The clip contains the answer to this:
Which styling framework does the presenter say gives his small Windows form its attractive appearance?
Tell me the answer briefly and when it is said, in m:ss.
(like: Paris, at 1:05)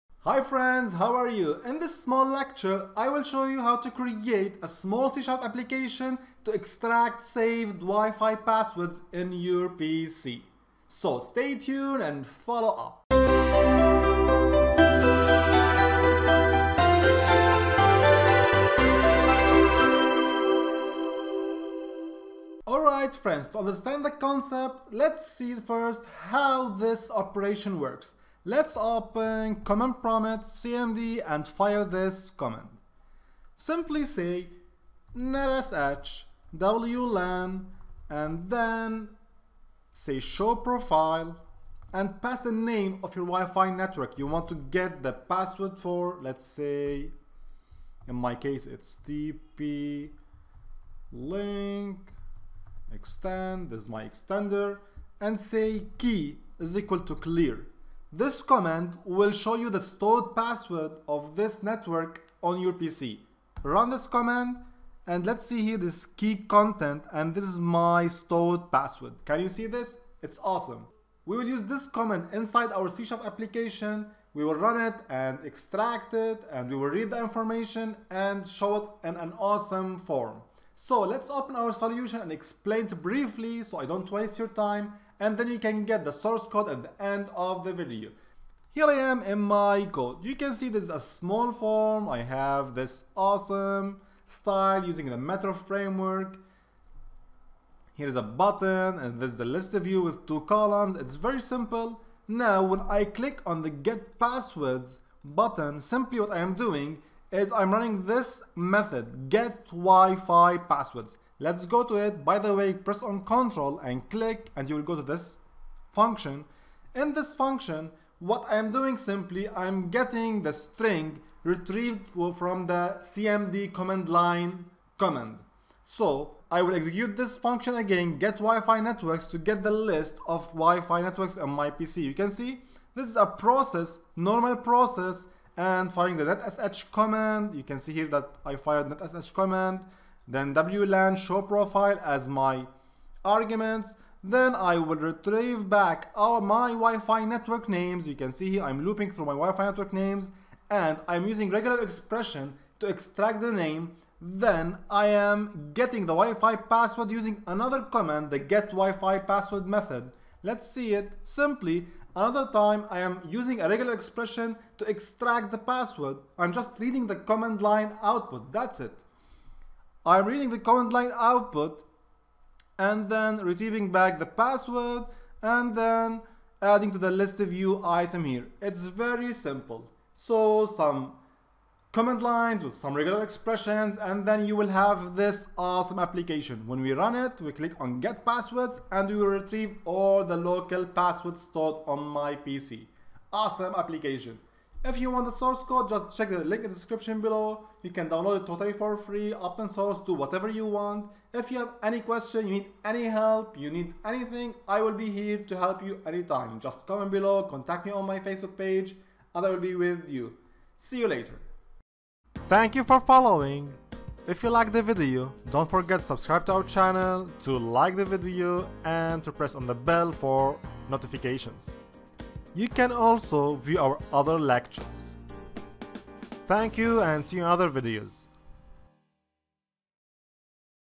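Metro, at 1:35.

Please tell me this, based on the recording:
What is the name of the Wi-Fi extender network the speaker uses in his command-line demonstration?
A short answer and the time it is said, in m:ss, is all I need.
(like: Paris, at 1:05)
TP link extend, at 0:49.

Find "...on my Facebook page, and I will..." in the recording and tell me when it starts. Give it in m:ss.
3:27.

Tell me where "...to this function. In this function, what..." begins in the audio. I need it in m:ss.
1:54.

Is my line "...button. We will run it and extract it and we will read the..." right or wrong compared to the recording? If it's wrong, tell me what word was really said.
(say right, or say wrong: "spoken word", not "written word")
wrong: "application", not "button".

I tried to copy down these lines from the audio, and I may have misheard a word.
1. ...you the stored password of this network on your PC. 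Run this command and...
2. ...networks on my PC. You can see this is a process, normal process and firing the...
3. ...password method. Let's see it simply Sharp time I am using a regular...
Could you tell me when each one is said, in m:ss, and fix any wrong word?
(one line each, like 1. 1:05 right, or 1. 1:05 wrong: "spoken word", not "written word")
1. 0:59 right
2. 2:11 right
3. 2:39 wrong: "Another", not "Sharp".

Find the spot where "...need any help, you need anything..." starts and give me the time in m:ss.
3:22.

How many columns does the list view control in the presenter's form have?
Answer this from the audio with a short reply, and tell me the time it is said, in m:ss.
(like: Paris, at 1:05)
2, at 1:40.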